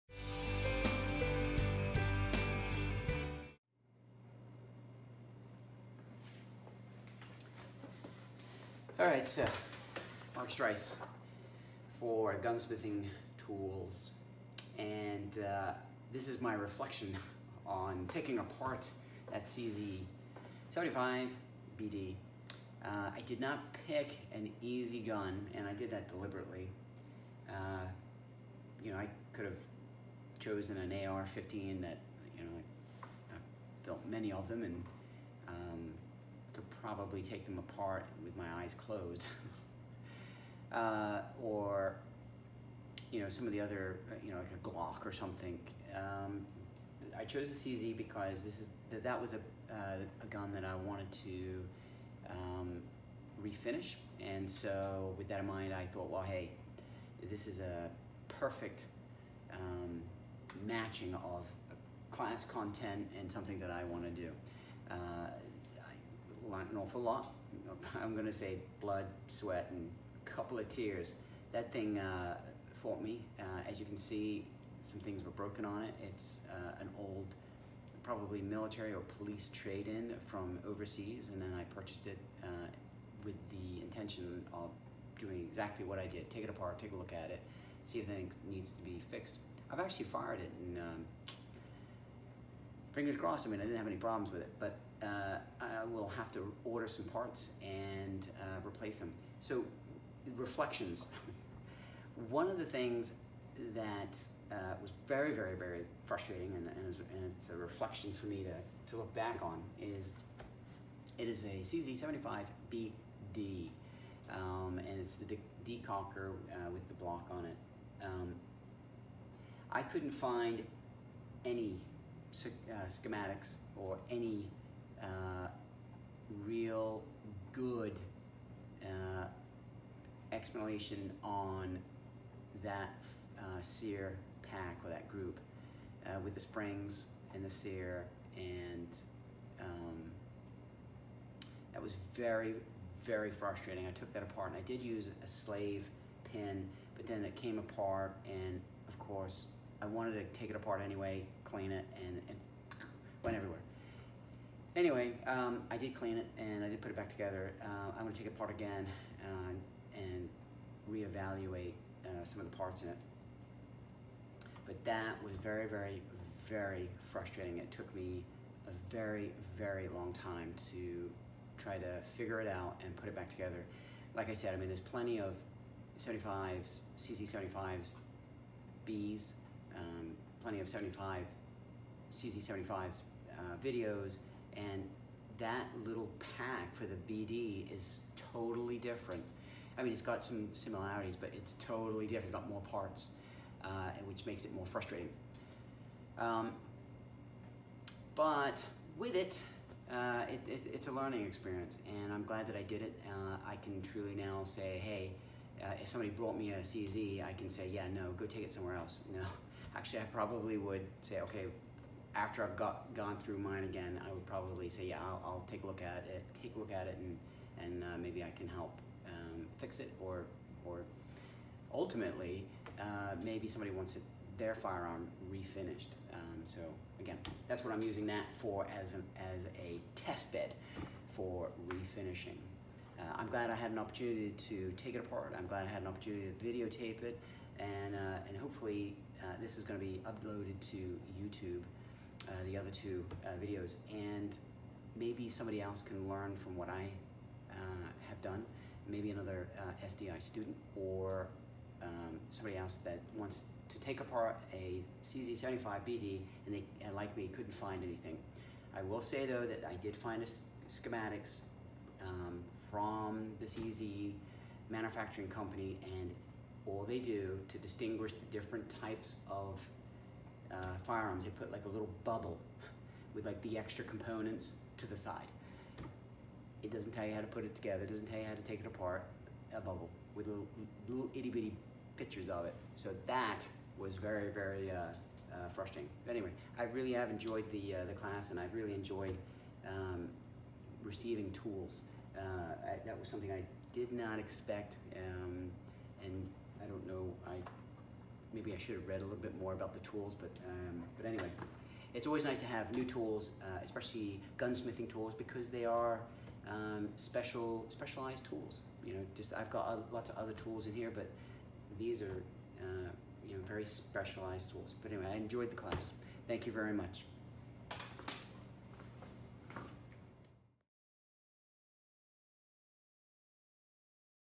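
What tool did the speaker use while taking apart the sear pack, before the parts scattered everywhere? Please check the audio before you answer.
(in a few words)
slave pin.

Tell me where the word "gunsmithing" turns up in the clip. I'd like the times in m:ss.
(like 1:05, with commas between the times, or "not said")
0:12, 5:04.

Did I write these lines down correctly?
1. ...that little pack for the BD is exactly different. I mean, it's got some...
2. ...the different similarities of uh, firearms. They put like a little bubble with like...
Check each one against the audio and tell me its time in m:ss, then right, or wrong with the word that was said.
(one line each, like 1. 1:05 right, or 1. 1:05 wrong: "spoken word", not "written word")
1. 3:05 wrong: "totally", not "exactly"
2. 4:28 wrong: "types", not "similarities".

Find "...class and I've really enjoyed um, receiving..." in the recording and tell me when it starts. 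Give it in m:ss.
4:47.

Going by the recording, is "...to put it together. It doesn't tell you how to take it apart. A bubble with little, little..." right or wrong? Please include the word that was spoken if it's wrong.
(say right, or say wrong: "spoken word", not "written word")
right.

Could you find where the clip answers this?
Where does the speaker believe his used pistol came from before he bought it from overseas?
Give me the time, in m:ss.
1:18.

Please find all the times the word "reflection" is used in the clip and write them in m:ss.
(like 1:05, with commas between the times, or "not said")
0:16, 1:40, 1:47.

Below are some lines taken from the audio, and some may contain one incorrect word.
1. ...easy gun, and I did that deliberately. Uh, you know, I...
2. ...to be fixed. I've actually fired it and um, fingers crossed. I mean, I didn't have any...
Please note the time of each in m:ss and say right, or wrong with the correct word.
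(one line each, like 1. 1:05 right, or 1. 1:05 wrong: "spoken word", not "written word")
1. 0:24 right
2. 1:28 right.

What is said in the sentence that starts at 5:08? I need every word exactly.
You know, just I've got a, uh, lots of other tools in here, but these are, uh, you know, very specialized tools.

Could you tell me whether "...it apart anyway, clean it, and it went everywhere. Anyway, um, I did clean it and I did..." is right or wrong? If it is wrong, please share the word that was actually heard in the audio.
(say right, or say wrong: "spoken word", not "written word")
right.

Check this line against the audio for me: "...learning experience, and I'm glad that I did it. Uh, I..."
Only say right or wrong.
right.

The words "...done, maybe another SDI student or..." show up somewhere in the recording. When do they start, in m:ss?
4:08.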